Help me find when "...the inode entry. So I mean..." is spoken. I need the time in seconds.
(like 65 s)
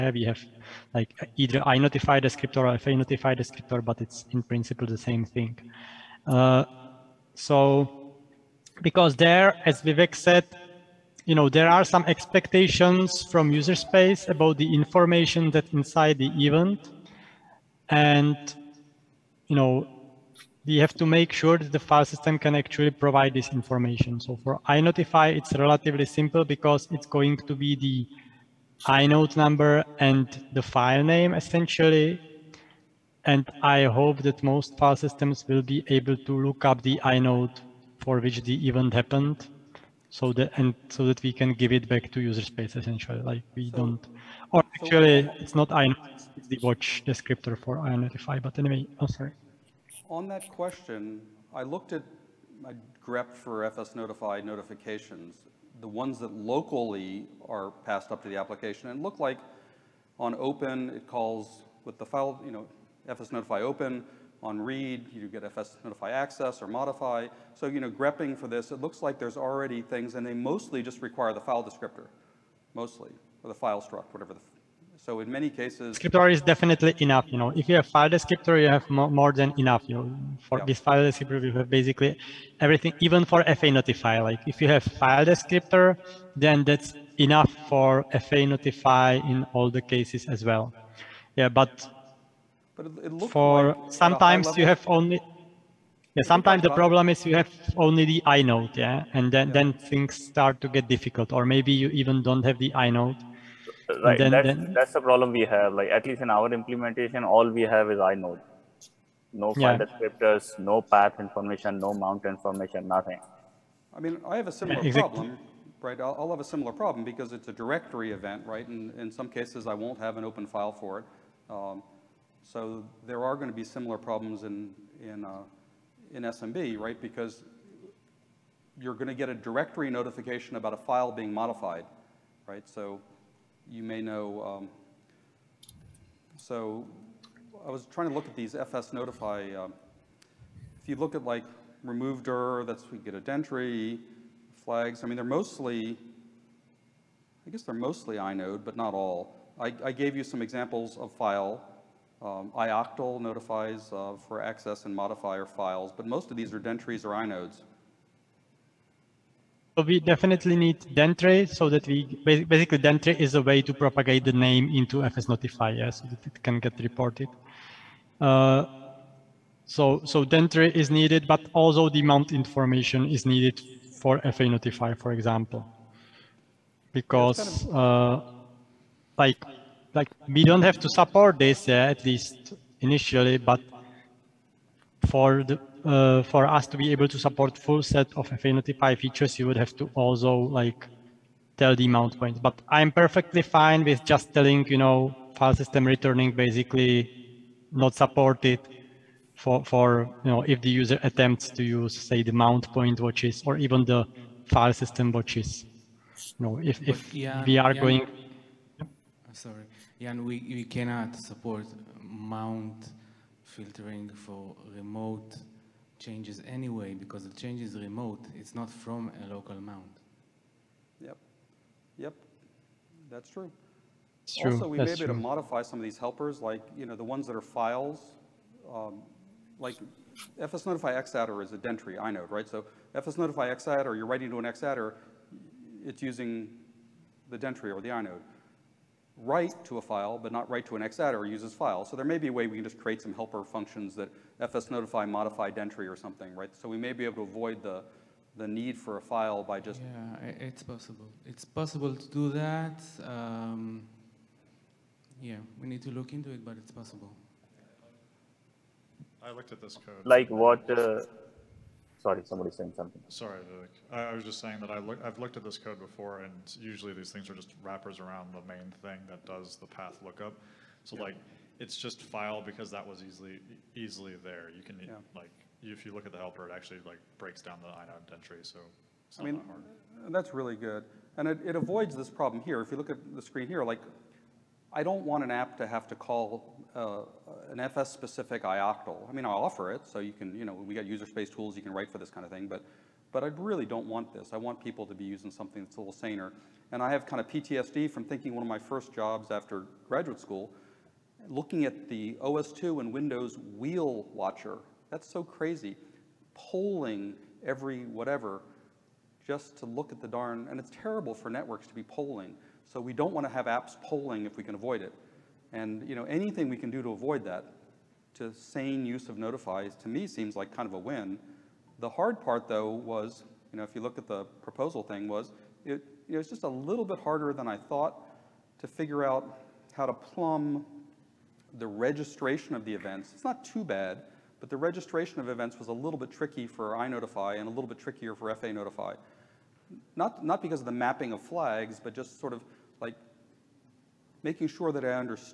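277 s.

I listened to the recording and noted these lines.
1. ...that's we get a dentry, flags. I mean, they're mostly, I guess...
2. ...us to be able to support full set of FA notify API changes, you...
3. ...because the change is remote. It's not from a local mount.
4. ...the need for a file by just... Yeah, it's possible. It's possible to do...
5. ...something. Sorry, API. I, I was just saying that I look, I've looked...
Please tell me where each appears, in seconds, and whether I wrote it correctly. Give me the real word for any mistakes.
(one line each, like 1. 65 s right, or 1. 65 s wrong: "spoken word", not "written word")
1. 142 s right
2. 186 s wrong: "features", not "changes"
3. 216 s right
4. 248 s right
5. 262 s wrong: "Vivek", not "API".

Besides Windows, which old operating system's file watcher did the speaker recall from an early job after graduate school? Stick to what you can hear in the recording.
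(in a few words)
OS2.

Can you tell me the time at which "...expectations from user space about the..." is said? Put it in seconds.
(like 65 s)
12 s.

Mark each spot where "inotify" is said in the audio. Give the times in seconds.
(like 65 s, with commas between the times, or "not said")
24 s, 47 s, 336 s.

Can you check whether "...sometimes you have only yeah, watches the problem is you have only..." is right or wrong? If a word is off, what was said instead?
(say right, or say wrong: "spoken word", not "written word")
wrong: "sometimes", not "watches".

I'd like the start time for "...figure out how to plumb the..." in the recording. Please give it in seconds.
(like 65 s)
328 s.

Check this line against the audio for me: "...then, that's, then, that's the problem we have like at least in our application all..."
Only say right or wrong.
wrong.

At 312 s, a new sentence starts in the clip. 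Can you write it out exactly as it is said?
So we don't want to have apps polling if we can avoid it.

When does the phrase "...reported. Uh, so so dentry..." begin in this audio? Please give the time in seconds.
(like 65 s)
166 s.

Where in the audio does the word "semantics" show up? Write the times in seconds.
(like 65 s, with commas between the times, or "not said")
not said.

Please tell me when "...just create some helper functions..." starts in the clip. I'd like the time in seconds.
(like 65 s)
242 s.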